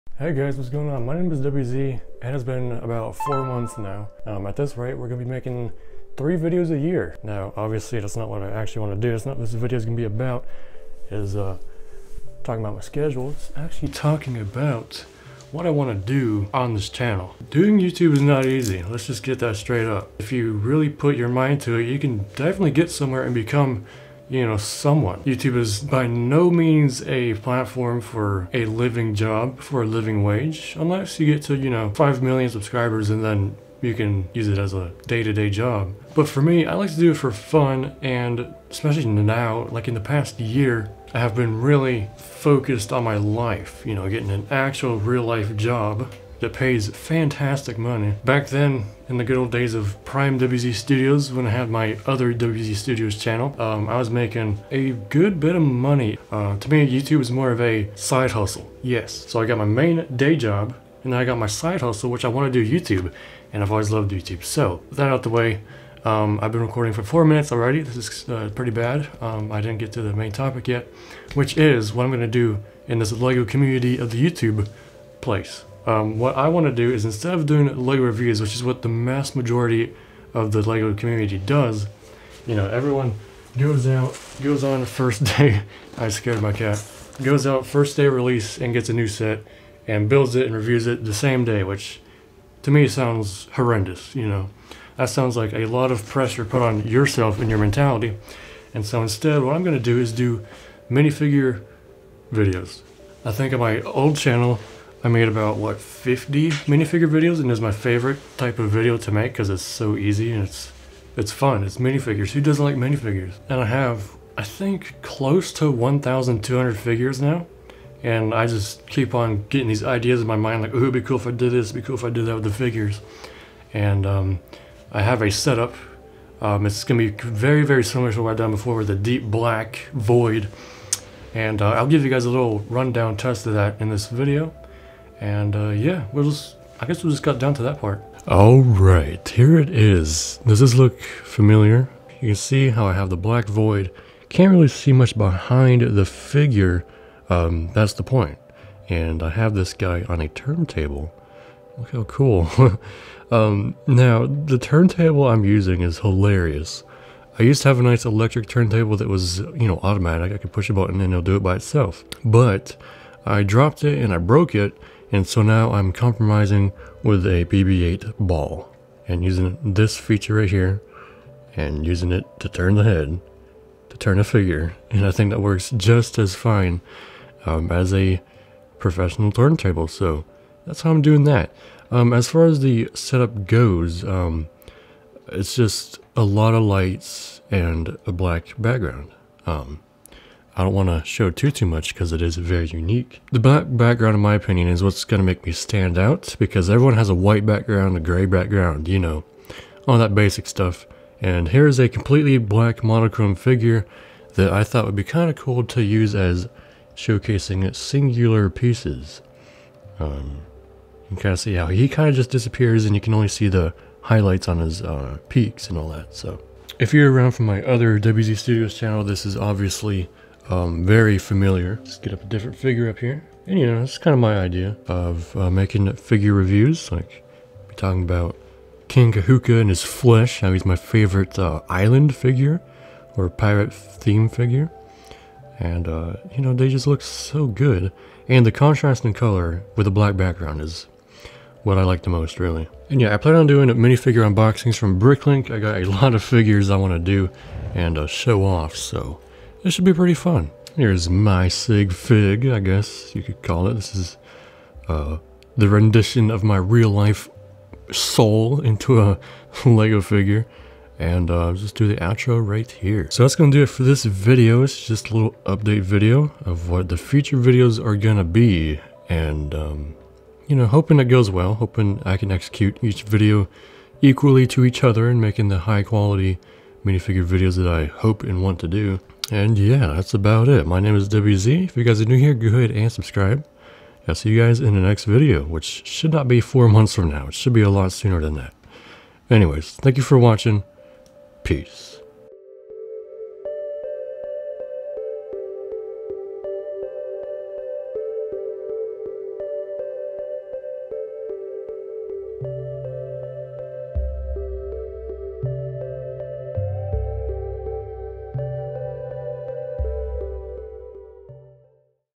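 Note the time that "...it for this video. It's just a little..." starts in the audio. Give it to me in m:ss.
4:23.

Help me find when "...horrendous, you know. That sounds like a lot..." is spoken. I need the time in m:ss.
1:33.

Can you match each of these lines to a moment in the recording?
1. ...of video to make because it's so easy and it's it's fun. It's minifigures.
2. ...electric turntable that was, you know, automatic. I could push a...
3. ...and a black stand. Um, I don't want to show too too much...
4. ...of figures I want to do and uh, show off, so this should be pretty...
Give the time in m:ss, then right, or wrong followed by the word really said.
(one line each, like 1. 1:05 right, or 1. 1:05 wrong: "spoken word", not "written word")
1. 1:48 right
2. 2:38 right
3. 3:07 wrong: "background", not "stand"
4. 4:06 right.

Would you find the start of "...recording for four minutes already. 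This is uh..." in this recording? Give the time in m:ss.
1:06.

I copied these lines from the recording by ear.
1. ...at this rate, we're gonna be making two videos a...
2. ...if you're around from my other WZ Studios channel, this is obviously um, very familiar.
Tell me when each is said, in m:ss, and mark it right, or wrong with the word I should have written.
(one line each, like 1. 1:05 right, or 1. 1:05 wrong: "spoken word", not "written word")
1. 0:04 wrong: "three", not "two"
2. 3:36 right.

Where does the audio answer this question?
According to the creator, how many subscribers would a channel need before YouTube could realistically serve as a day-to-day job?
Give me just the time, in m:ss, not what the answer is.
0:31.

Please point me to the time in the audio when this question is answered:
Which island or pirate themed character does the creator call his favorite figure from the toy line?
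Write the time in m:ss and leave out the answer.
3:48.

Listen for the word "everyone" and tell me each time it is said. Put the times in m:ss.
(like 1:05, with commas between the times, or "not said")
1:22, 3:16.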